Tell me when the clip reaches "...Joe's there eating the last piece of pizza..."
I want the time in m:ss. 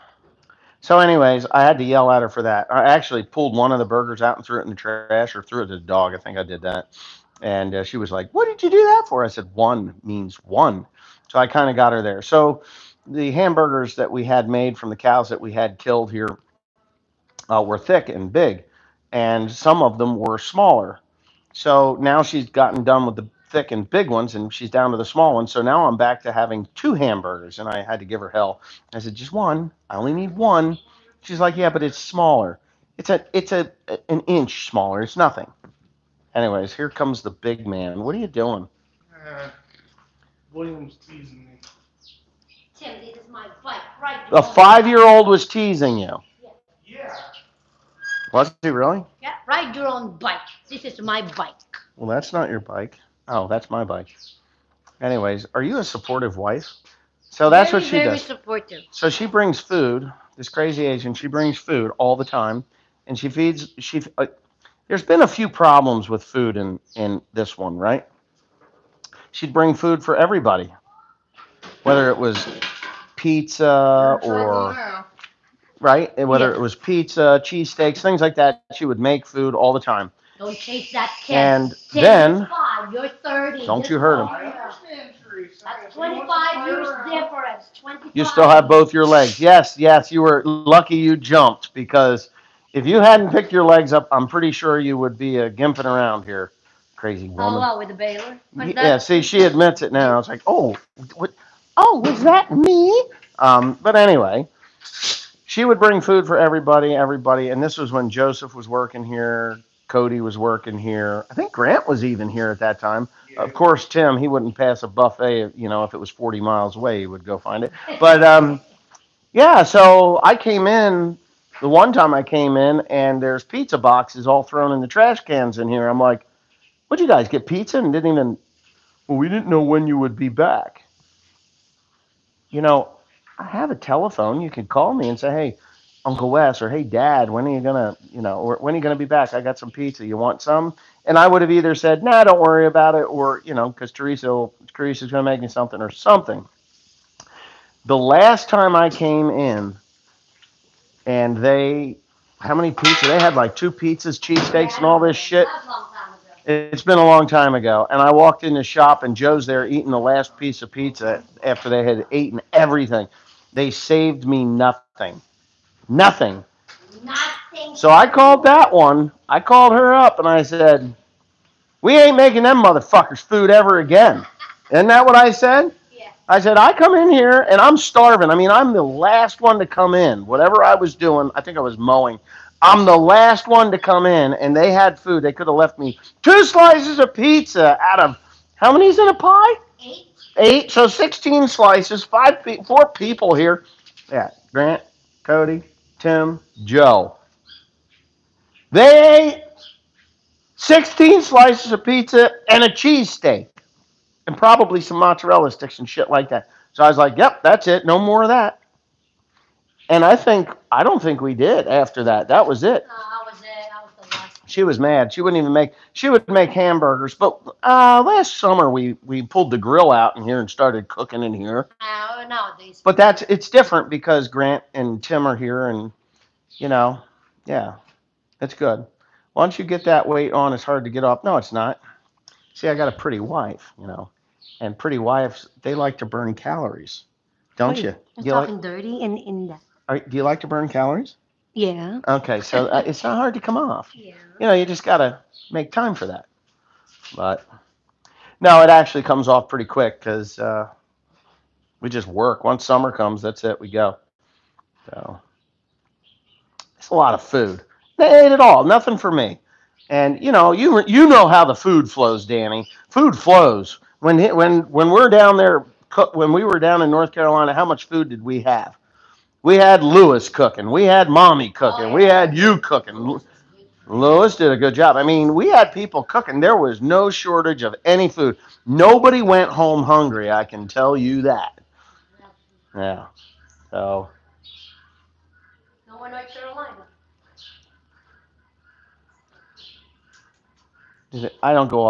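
2:39.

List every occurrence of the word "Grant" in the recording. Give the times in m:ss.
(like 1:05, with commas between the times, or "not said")
1:51, 3:14, 3:44.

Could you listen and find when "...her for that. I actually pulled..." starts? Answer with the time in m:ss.
0:02.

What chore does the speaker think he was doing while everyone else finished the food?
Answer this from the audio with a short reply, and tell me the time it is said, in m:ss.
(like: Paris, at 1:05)
Mowing, at 3:01.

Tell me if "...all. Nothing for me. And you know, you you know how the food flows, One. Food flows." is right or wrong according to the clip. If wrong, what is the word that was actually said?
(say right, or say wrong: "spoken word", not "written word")
wrong: "Danny", not "One".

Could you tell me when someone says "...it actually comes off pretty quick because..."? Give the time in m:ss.
4:08.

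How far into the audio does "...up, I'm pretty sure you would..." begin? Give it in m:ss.
1:33.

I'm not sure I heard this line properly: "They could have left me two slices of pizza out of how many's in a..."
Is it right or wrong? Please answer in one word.
right.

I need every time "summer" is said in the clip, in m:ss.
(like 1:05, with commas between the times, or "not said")
3:38, 4:12.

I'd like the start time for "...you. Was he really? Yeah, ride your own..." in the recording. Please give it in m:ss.
0:45.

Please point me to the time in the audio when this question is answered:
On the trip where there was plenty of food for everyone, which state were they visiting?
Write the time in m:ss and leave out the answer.
4:26.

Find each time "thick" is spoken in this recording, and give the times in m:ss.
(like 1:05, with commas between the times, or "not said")
0:17, 0:23.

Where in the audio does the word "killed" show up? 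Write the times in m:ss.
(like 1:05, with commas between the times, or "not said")
0:15.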